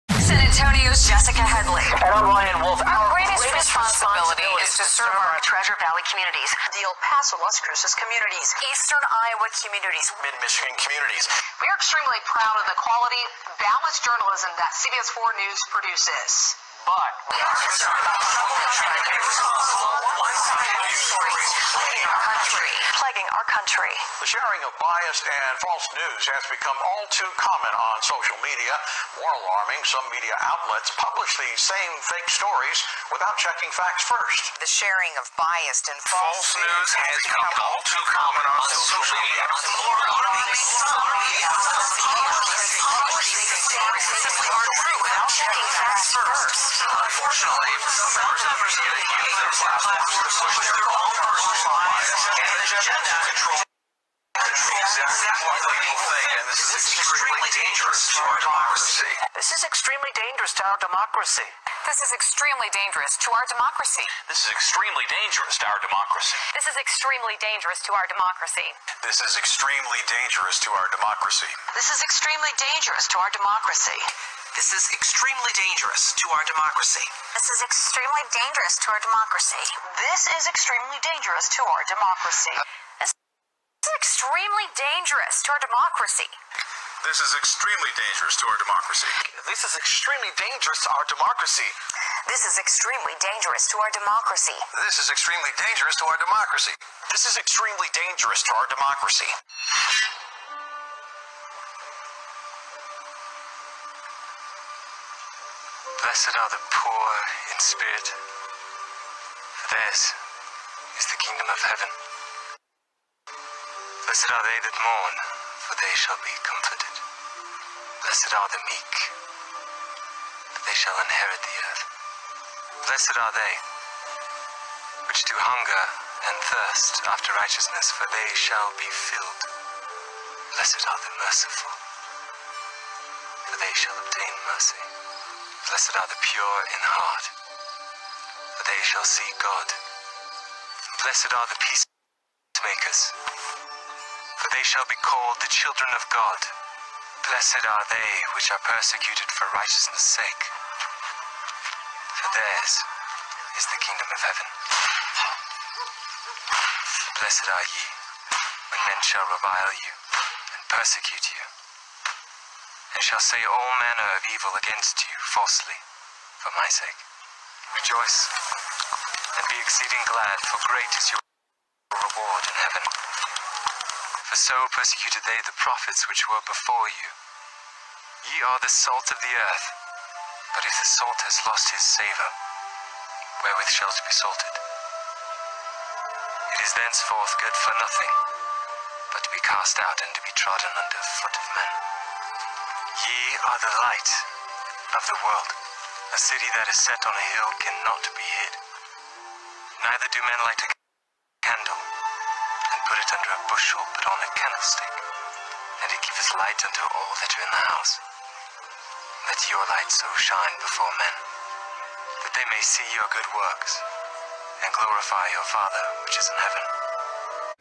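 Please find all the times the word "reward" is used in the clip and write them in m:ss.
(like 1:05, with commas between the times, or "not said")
2:51.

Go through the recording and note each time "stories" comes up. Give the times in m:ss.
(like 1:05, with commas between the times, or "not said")
0:20, 0:32, 0:44.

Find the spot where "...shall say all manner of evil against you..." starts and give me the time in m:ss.
2:43.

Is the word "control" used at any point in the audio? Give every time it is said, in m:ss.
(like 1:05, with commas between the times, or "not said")
0:53.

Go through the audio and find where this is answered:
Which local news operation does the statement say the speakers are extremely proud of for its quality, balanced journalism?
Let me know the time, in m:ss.
0:14.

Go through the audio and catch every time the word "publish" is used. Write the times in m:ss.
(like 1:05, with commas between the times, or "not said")
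0:30, 0:42.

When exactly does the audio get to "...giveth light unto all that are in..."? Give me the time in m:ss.
3:26.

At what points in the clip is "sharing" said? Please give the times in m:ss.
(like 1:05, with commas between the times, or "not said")
0:24, 0:34.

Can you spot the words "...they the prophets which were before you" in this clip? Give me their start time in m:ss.
2:55.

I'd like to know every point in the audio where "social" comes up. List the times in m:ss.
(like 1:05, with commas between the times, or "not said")
0:28, 0:38.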